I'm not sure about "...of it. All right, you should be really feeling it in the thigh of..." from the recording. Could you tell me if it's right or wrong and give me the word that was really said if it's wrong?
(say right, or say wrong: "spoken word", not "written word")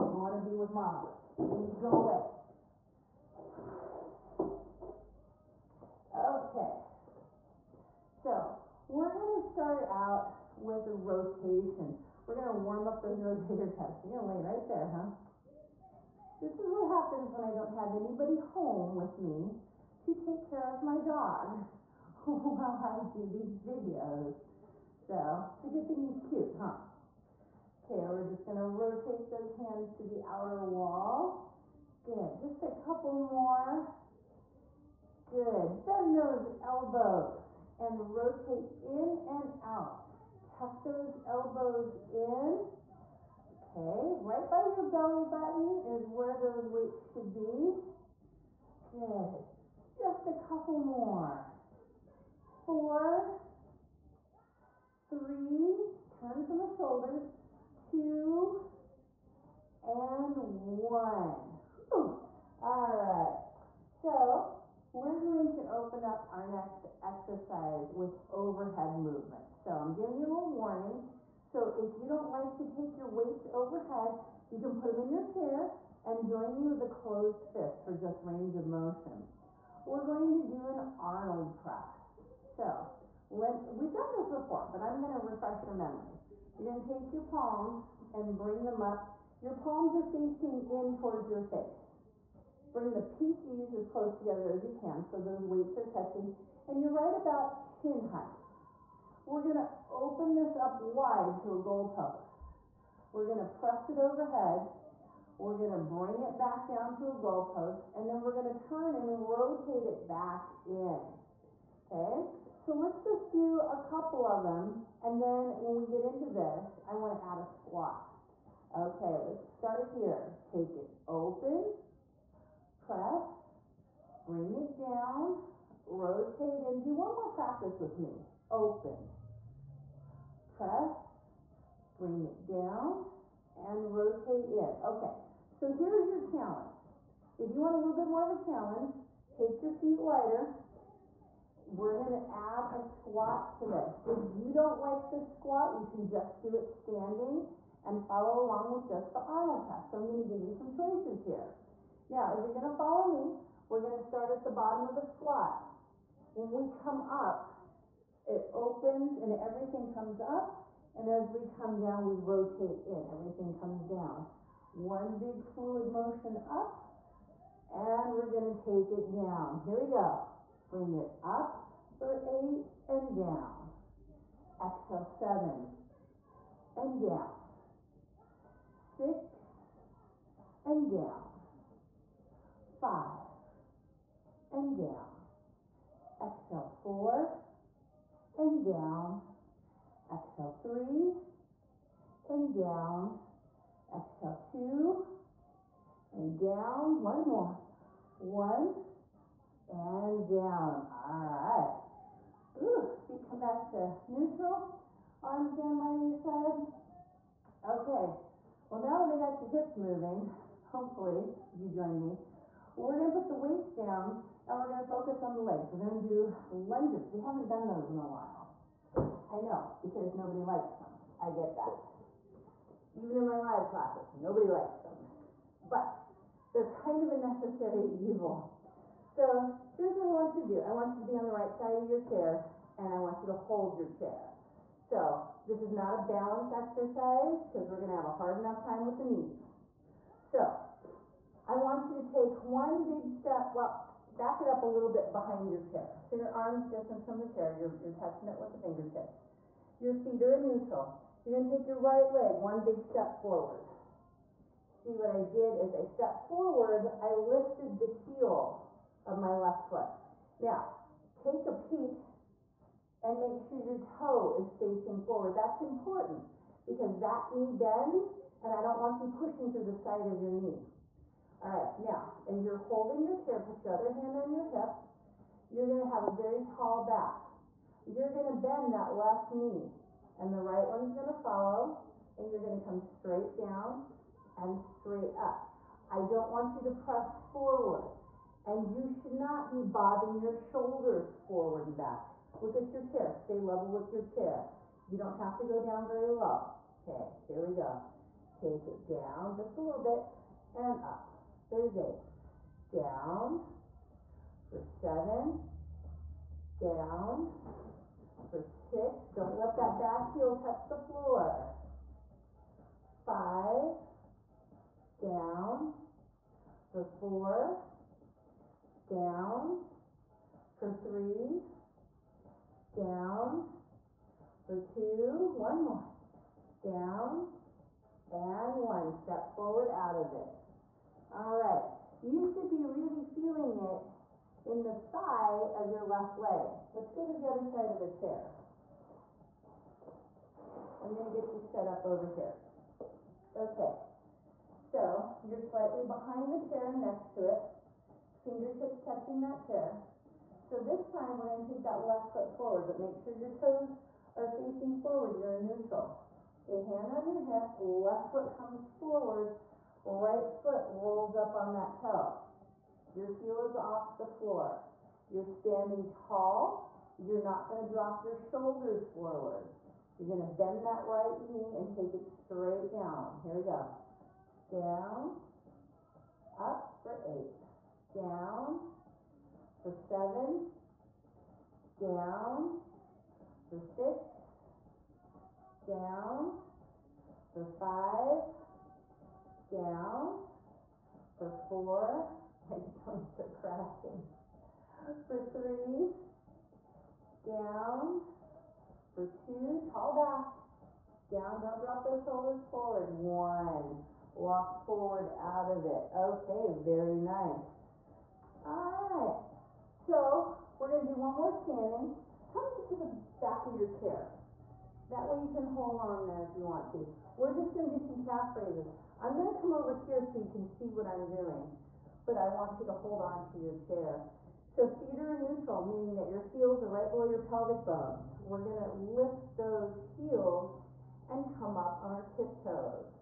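right.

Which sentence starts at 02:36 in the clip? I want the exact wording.
When we come up, it opens and everything comes up.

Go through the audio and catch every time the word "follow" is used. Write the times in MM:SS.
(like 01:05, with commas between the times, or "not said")
02:28, 02:32, 04:41.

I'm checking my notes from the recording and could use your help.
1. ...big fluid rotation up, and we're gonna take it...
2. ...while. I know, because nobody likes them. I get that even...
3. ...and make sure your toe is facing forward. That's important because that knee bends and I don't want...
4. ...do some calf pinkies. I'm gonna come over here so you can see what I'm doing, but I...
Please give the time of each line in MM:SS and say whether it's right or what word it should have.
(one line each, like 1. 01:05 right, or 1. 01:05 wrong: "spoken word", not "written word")
1. 02:45 wrong: "motion", not "rotation"
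2. 03:38 right
3. 04:23 right
4. 06:57 wrong: "raises", not "pinkies".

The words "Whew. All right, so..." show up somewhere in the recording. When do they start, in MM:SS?
01:01.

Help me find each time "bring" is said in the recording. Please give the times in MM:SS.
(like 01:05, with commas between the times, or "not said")
01:28, 01:32, 01:45, 02:04, 02:11, 02:50.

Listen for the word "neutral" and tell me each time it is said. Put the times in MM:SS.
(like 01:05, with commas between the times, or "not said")
03:24, 04:10, 05:55, 07:05.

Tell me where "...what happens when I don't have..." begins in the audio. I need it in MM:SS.
00:16.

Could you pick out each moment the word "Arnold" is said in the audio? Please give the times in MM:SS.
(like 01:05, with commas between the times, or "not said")
01:20, 02:29.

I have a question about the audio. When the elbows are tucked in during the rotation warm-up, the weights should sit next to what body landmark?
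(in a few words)
belly button.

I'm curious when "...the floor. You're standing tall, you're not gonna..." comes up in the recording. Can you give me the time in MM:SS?
06:03.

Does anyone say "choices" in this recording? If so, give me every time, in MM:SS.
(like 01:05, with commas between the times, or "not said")
02:30.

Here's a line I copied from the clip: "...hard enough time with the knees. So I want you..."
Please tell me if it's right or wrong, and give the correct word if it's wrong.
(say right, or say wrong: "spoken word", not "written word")
right.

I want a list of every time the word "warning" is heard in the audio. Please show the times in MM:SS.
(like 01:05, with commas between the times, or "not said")
01:10.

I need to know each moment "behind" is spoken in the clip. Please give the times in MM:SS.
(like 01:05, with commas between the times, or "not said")
04:05, 05:45.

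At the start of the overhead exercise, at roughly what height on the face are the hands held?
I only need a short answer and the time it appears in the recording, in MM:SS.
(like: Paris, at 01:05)
chin height, at 01:37.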